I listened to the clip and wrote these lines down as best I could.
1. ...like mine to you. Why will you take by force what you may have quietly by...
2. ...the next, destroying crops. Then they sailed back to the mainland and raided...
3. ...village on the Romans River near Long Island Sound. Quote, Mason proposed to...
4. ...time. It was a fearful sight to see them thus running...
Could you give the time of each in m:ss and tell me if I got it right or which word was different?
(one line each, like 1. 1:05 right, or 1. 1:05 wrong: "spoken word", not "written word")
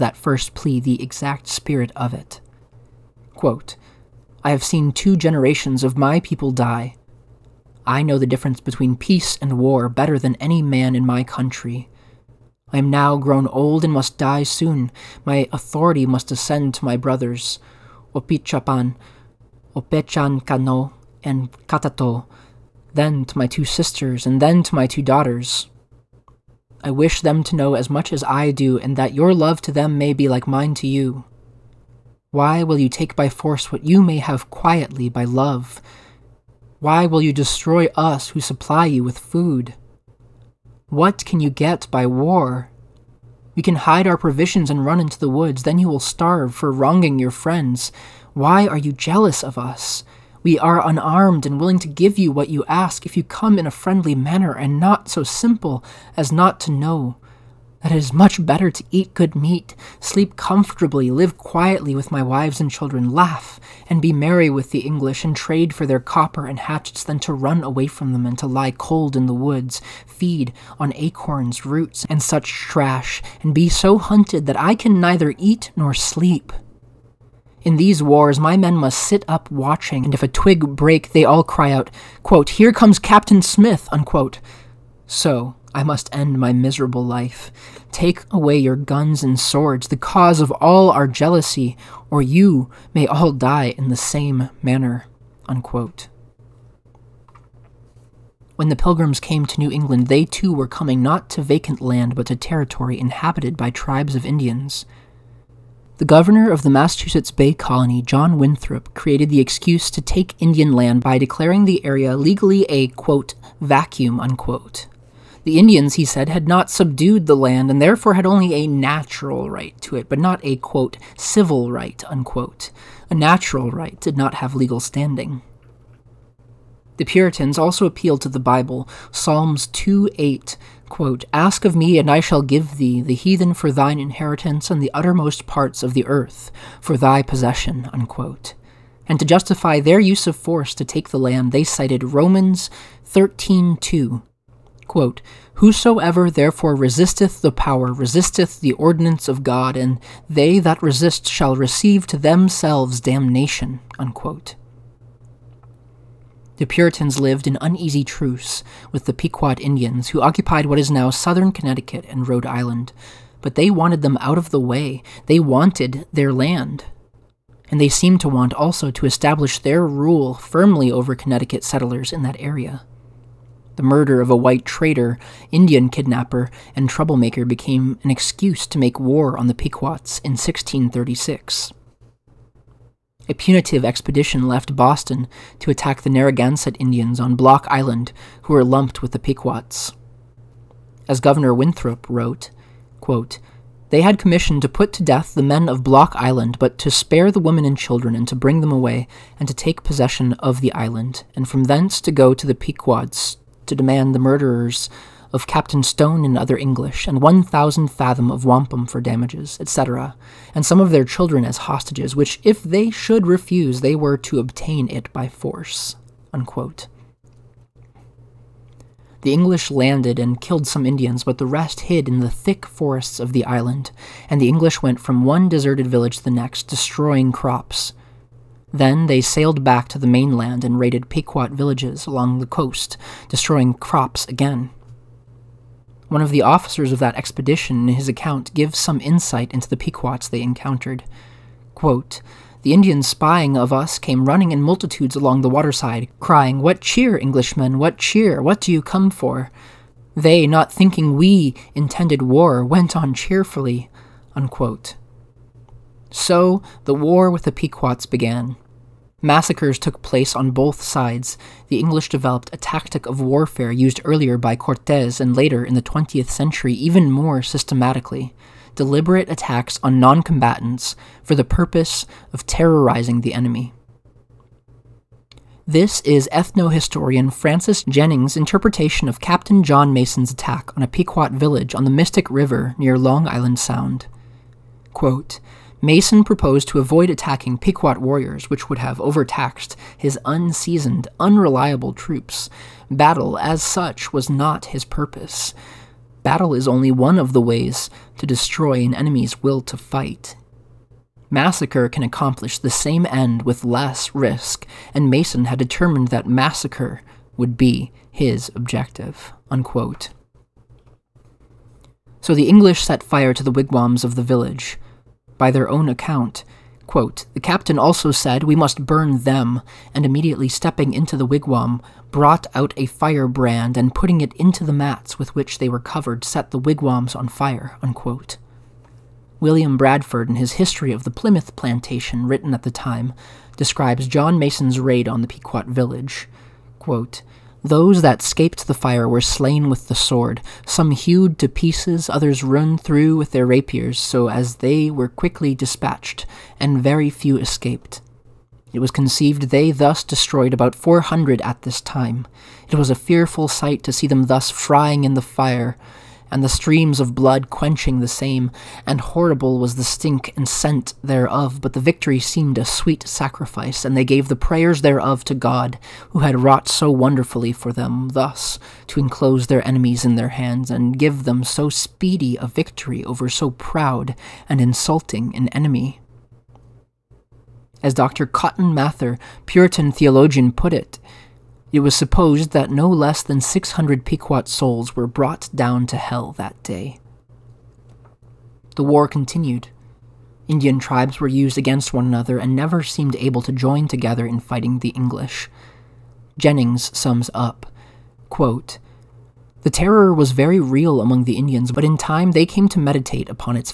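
1. 0:30 right
2. 3:46 right
3. 4:41 wrong: "Mystic", not "Romans"
4. 5:51 wrong: "frying", not "running".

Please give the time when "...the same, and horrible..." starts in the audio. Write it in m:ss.
5:58.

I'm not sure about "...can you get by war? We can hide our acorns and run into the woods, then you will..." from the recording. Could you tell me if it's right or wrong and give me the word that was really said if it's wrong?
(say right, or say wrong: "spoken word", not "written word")
wrong: "provisions", not "acorns".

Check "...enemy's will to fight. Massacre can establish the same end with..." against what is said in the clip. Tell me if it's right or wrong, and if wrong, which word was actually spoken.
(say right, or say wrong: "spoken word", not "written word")
wrong: "accomplish", not "establish".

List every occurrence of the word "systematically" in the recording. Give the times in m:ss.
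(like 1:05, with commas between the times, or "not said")
4:27.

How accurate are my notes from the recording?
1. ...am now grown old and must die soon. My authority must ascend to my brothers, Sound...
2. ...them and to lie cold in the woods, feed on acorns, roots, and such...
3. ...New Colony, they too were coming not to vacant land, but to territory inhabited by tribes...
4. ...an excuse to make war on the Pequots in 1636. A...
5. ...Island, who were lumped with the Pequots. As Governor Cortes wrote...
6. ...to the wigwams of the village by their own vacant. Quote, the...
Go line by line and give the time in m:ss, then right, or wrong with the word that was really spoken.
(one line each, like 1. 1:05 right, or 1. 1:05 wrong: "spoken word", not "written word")
1. 0:12 wrong: "Opitchapan", not "Sound"
2. 1:08 right
3. 1:39 wrong: "England", not "Colony"
4. 2:58 right
5. 3:07 wrong: "Winthrop", not "Cortes"
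6. 5:13 wrong: "account", not "vacant".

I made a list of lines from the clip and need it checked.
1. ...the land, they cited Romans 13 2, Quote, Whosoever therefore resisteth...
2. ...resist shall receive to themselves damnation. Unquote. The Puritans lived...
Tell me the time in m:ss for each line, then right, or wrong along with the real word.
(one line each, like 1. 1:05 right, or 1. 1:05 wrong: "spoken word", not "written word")
1. 2:21 right
2. 2:30 right.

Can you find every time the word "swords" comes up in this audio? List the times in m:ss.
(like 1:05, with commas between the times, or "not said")
1:29, 5:39.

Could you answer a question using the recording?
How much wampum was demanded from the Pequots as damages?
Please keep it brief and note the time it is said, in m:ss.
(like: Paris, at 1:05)
1,000 fathom, at 3:27.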